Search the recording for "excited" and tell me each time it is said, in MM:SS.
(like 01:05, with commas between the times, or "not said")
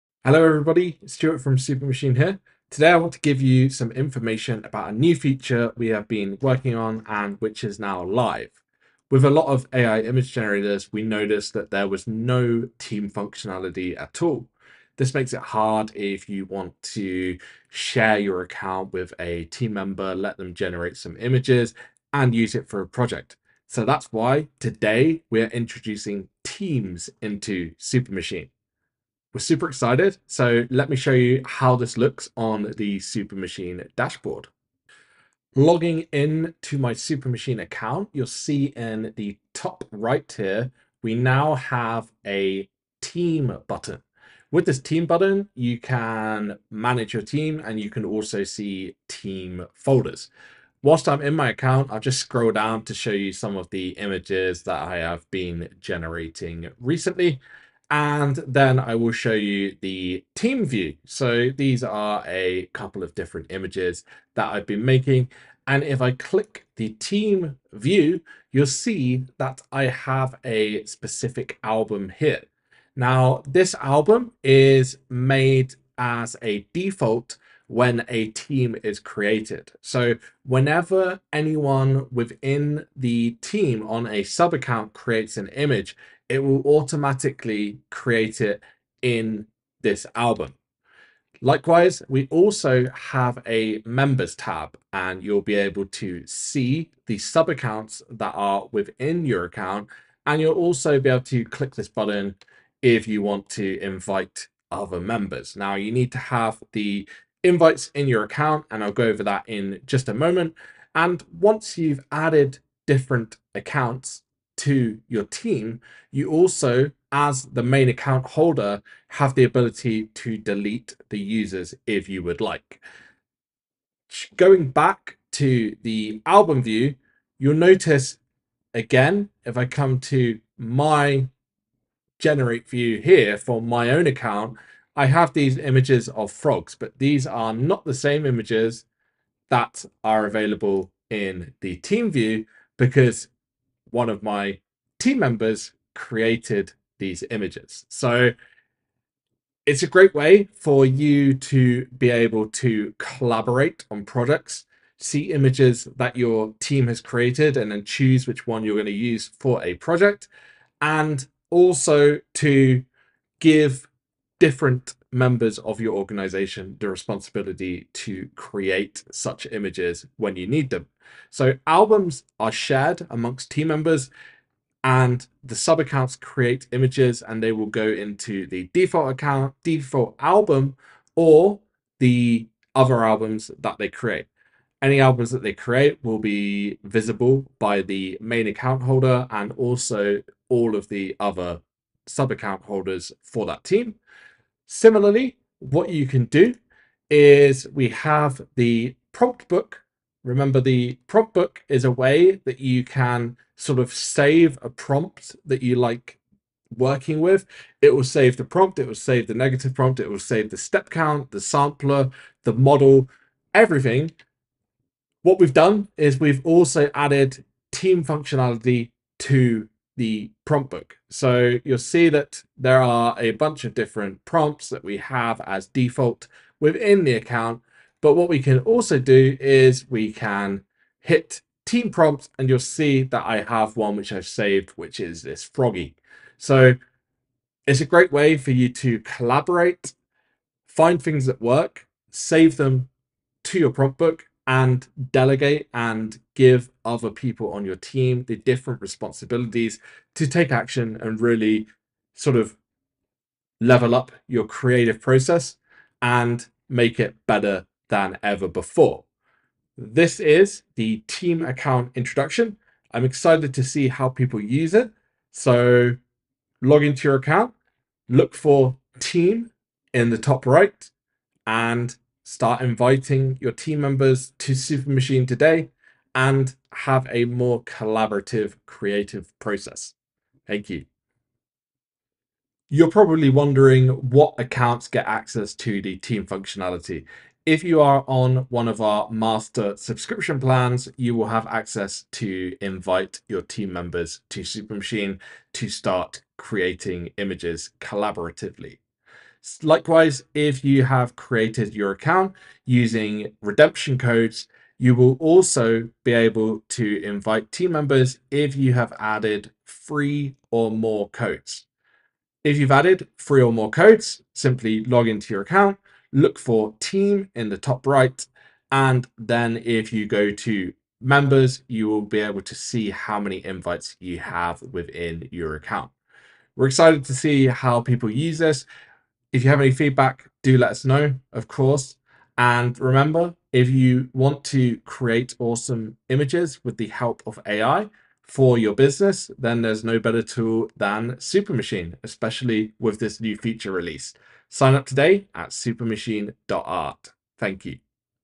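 00:29, 04:23, 05:26.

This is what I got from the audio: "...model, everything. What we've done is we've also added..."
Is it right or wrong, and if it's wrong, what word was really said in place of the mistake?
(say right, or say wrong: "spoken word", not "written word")
right.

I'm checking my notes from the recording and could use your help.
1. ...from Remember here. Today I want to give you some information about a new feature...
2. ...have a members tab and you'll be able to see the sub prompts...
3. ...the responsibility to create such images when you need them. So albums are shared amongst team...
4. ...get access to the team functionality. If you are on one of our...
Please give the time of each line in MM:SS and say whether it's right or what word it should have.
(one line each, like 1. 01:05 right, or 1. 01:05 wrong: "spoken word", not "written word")
1. 00:01 wrong: "Supermachine", not "Remember"
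2. 01:32 wrong: "accounts", not "prompts"
3. 02:46 right
4. 04:44 right.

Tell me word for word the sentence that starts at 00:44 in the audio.
With this team button, you can manage your team and you can also see team folders.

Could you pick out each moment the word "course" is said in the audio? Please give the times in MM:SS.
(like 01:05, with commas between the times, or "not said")
05:31.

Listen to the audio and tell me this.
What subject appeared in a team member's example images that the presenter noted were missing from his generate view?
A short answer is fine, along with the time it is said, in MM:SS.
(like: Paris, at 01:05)
frogs, at 02:16.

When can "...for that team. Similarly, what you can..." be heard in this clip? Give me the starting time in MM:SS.
03:13.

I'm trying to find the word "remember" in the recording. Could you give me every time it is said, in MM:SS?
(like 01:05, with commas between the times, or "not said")
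03:20, 05:32.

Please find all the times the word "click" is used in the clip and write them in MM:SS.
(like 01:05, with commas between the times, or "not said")
01:06, 01:41.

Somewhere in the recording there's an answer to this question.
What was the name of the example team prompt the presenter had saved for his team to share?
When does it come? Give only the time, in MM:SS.
03:55.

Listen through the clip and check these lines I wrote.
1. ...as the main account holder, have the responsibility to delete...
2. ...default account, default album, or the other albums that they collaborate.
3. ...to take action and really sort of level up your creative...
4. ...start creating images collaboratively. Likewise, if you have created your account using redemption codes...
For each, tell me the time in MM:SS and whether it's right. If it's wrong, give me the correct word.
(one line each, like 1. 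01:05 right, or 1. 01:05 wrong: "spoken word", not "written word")
1. 01:57 wrong: "ability", not "responsibility"
2. 02:58 wrong: "create", not "collaborate"
3. 04:10 right
4. 04:55 right.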